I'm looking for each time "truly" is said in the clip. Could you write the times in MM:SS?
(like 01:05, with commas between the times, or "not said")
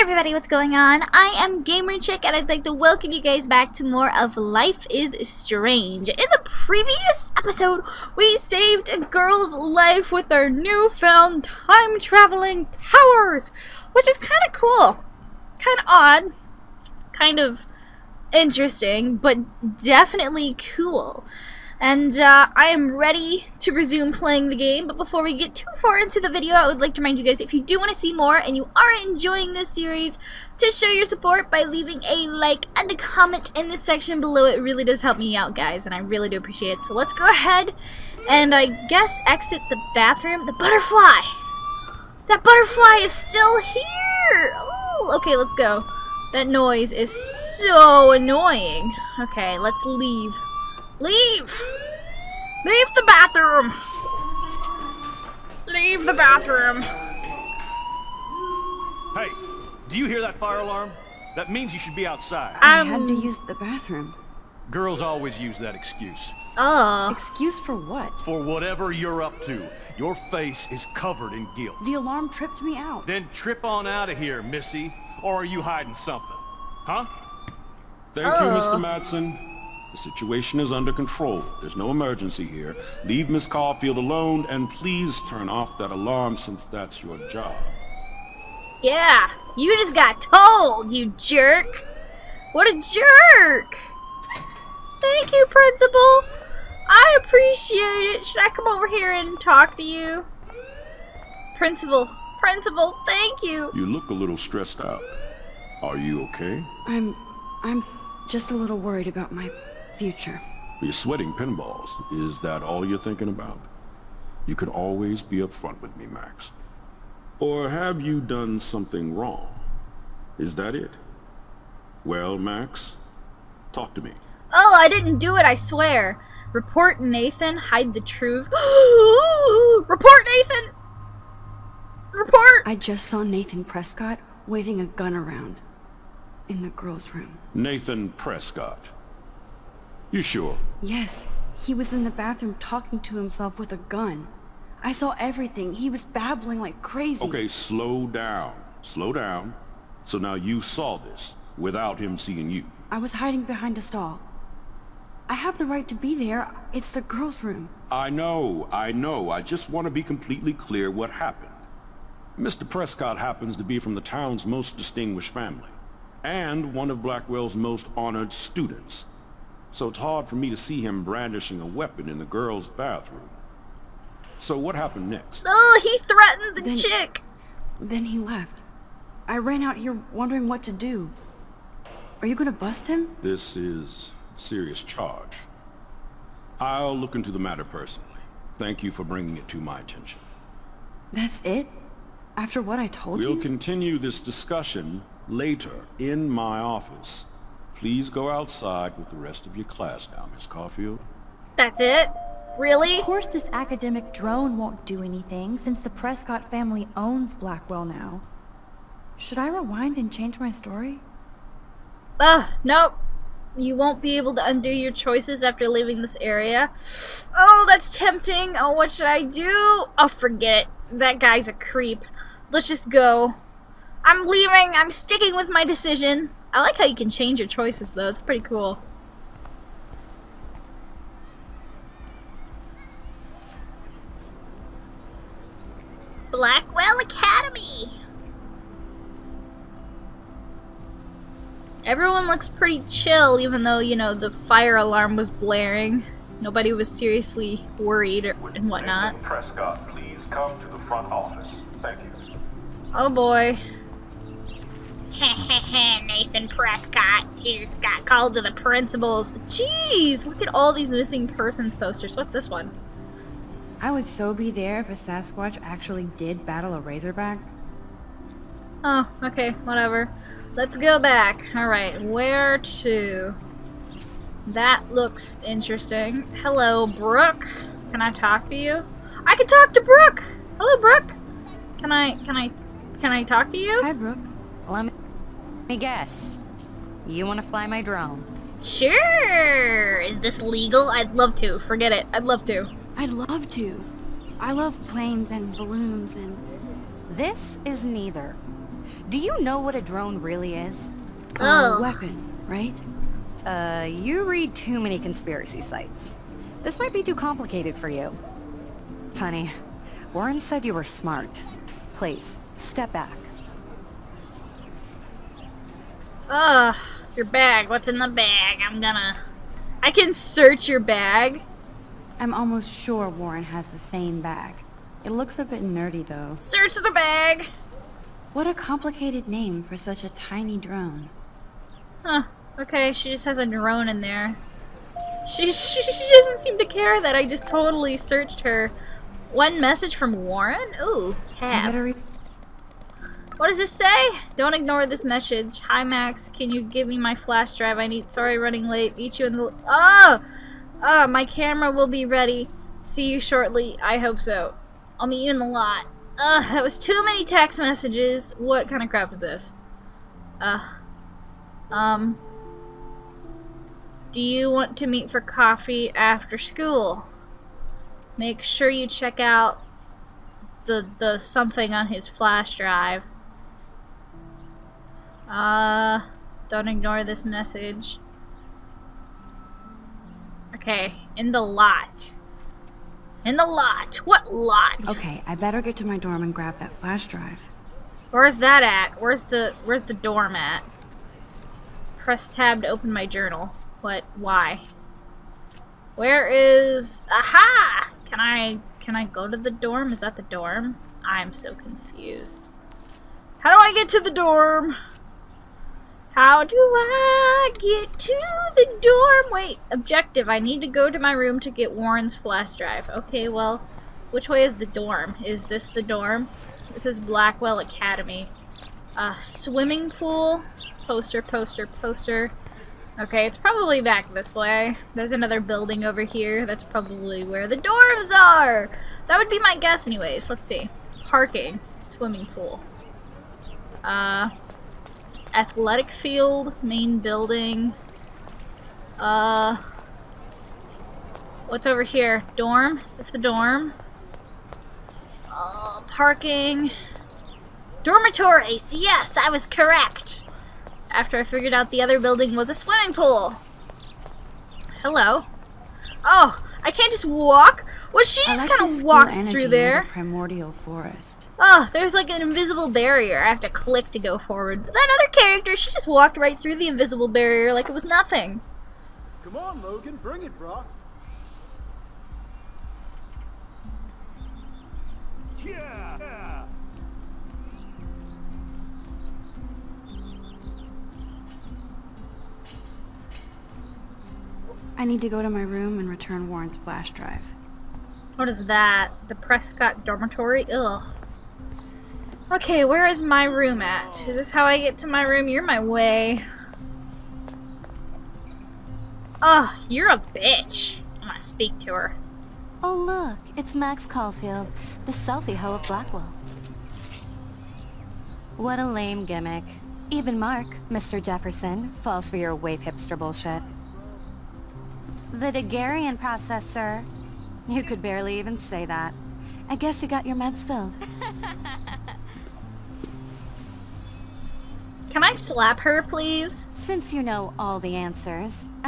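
not said.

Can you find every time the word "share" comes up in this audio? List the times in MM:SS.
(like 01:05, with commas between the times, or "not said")
not said.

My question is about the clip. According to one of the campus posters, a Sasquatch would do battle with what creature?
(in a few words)
a Razorback.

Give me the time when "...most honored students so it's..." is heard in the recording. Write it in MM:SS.
02:47.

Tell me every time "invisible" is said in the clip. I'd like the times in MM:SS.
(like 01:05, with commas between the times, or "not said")
07:42, 07:46.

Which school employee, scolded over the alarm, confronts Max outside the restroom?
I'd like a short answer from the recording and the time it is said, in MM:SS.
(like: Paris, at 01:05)
Mr. Madsen, at 01:18.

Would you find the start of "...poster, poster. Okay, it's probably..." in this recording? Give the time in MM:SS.
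07:01.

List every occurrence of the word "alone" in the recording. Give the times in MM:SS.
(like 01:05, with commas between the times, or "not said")
01:23.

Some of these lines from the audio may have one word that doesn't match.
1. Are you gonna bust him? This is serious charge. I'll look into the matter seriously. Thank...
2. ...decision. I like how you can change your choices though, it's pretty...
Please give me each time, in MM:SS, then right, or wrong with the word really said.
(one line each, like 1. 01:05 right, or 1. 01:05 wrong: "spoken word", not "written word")
1. 03:02 wrong: "personally", not "seriously"
2. 03:45 right.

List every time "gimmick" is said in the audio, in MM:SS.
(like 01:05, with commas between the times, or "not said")
08:29.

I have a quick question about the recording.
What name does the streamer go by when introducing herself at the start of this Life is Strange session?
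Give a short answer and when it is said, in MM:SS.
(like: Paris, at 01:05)
Gamer Chick, at 00:01.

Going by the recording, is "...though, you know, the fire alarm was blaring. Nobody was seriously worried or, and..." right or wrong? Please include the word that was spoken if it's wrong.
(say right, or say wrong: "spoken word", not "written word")
right.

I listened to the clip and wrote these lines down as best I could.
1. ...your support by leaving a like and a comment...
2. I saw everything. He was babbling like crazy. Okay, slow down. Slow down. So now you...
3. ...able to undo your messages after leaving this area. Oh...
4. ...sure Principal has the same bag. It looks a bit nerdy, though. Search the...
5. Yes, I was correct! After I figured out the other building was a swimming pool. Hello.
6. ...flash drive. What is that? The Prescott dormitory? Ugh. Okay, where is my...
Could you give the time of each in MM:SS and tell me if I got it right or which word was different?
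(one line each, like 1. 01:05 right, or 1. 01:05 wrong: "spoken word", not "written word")
1. 00:30 right
2. 02:24 right
3. 03:34 wrong: "choices", not "messages"
4. 05:22 wrong: "Warren", not "Principal"
5. 07:28 right
6. 08:06 right.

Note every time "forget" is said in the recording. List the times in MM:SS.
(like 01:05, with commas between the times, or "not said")
03:40, 04:51.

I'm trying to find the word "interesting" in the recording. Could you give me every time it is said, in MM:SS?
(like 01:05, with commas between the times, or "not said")
00:18, 04:35.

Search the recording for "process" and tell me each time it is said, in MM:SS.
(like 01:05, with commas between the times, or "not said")
08:35.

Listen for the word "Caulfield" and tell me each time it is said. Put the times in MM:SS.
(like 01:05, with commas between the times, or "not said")
01:23, 03:20, 08:23.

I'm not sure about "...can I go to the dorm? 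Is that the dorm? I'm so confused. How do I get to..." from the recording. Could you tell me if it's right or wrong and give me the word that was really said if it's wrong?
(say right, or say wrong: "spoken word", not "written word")
right.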